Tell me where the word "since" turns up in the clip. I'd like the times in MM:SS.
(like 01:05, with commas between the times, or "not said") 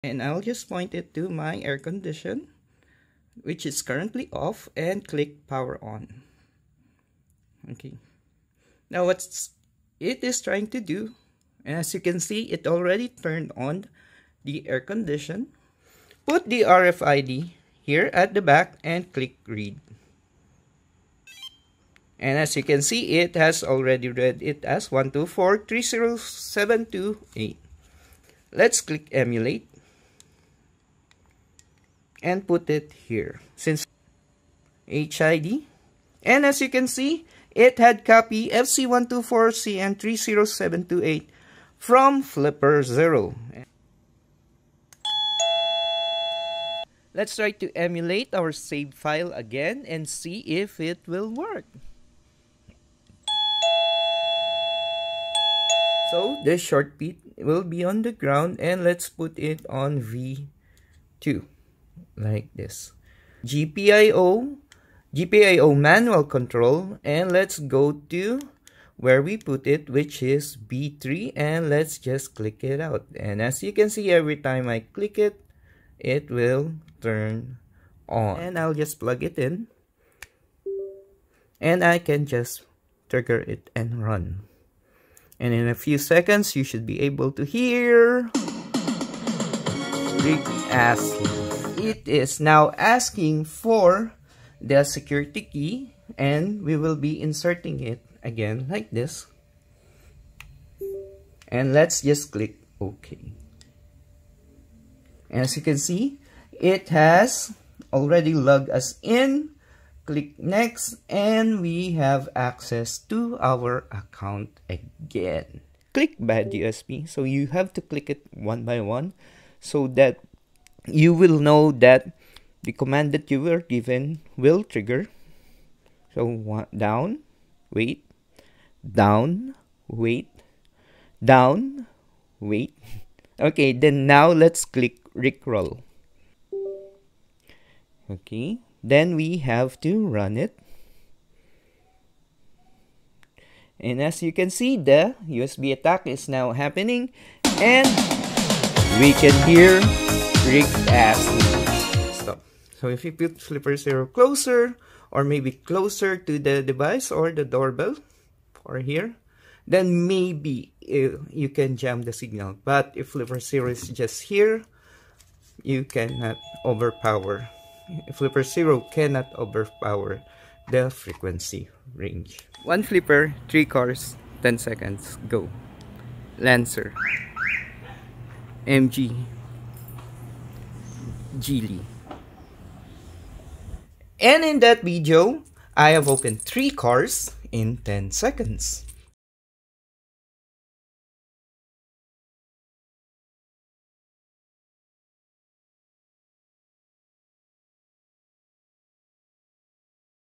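00:33.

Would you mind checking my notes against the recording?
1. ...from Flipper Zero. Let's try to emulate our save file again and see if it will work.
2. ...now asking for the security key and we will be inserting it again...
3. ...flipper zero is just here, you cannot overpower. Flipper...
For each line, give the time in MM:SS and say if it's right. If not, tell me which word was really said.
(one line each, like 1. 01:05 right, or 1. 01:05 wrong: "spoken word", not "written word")
1. 00:41 right
2. 01:32 right
3. 02:43 right.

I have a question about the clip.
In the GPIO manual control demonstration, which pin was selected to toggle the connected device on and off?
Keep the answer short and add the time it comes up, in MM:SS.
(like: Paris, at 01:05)
B3, at 01:10.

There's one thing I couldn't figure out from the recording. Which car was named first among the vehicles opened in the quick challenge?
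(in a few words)
Lancer.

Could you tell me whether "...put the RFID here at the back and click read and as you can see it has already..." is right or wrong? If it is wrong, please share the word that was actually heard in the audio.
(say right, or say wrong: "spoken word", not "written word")
right.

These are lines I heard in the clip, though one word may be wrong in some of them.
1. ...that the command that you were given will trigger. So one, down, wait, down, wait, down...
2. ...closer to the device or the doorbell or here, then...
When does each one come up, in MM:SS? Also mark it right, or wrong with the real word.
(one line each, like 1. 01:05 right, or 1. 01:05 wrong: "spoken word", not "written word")
1. 02:01 right
2. 02:35 right.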